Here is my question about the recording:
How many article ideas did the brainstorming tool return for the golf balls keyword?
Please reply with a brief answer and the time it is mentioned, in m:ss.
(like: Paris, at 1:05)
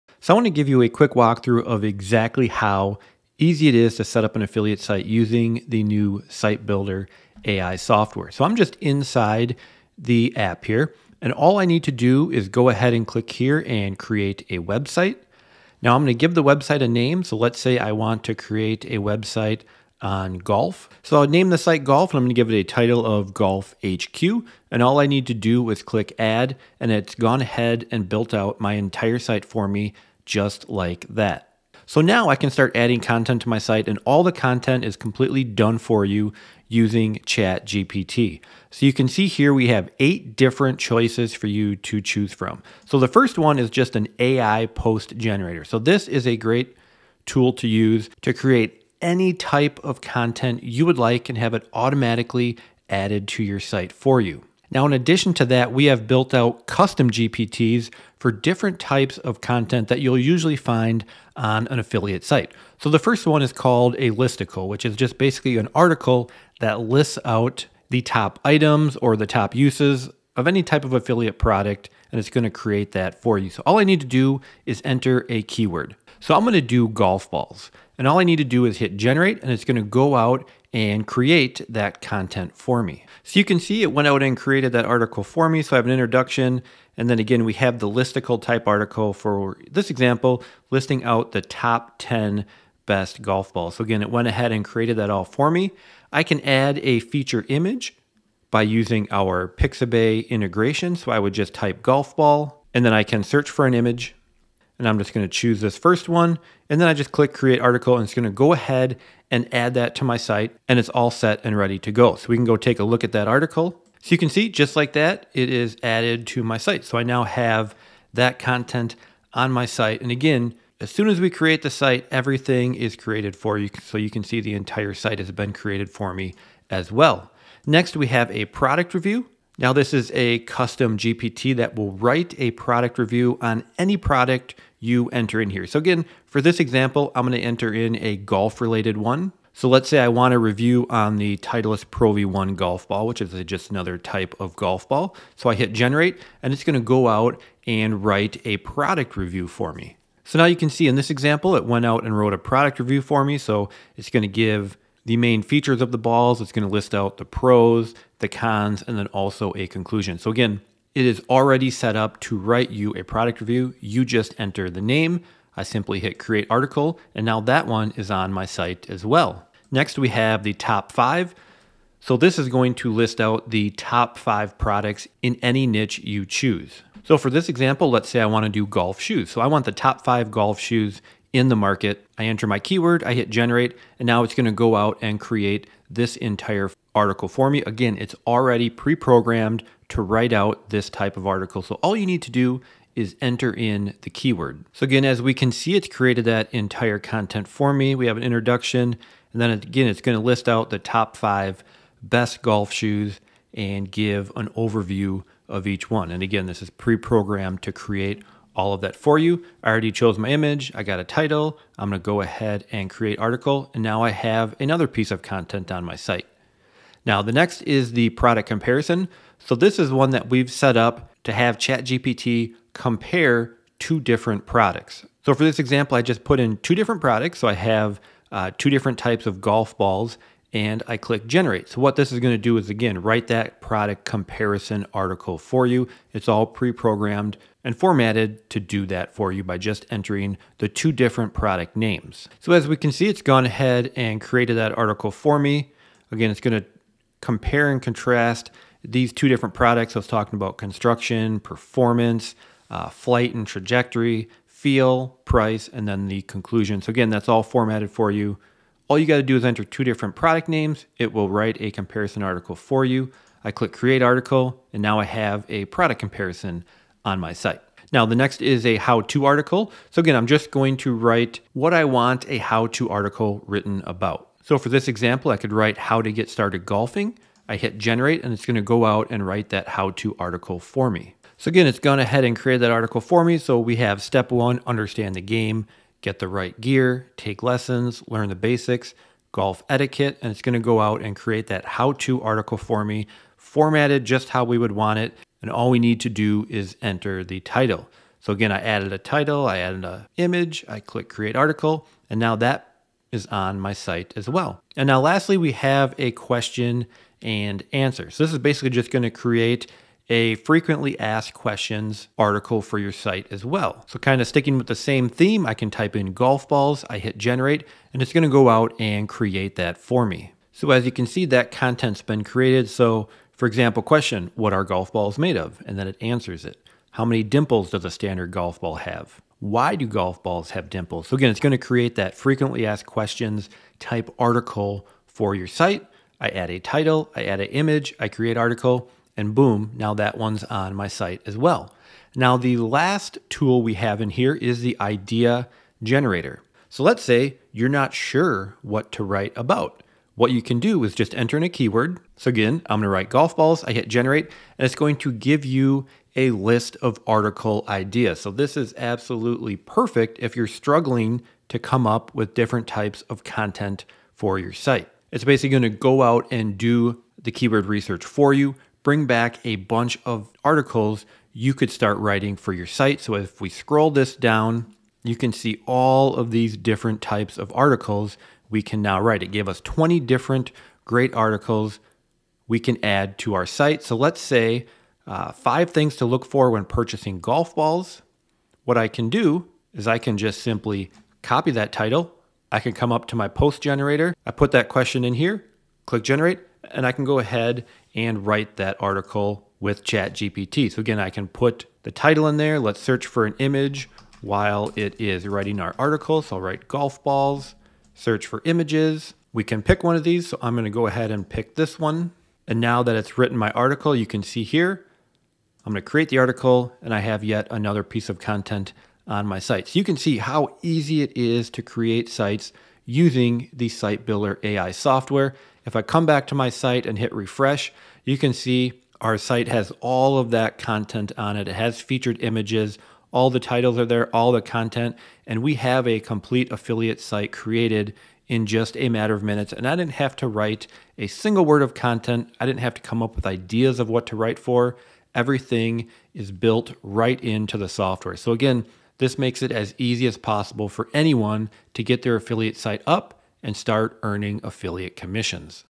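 20, at 6:19.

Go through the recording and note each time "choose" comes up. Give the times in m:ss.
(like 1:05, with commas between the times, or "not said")
0:41, 1:45, 2:56.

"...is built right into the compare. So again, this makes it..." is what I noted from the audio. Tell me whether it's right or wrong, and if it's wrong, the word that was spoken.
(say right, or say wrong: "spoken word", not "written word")
wrong: "software", not "compare".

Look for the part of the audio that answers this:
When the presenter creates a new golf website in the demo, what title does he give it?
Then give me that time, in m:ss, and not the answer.
0:23.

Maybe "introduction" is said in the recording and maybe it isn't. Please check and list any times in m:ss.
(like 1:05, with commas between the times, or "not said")
1:25, 3:18.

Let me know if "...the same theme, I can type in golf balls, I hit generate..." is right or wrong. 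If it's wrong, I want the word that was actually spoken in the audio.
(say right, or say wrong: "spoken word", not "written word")
right.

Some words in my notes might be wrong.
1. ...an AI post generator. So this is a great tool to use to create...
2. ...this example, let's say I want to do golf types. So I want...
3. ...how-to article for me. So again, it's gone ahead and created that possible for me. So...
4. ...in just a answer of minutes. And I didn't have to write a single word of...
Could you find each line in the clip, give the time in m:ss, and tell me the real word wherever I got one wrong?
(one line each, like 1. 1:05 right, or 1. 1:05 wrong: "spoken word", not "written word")
1. 0:43 right
2. 2:57 wrong: "shoes", not "types"
3. 4:39 wrong: "article", not "possible"
4. 7:18 wrong: "matter", not "answer".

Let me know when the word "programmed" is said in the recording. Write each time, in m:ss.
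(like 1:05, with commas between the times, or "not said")
3:08, 3:26, 3:56.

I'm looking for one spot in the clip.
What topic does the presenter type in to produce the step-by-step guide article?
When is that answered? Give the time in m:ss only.
4:35.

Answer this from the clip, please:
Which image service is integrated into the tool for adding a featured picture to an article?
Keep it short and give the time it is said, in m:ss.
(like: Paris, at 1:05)
Pixabay, at 1:39.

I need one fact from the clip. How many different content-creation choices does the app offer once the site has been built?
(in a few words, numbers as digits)
8.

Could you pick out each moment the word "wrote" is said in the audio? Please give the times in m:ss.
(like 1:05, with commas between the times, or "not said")
2:32.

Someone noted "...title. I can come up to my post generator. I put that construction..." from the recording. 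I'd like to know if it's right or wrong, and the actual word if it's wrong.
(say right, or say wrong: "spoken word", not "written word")
wrong: "question", not "construction".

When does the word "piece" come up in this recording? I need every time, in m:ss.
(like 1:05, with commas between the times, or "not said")
3:34, 6:57.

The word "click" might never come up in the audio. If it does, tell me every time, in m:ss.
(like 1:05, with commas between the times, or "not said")
0:13, 0:25, 1:47, 3:50, 4:23, 5:00, 6:35.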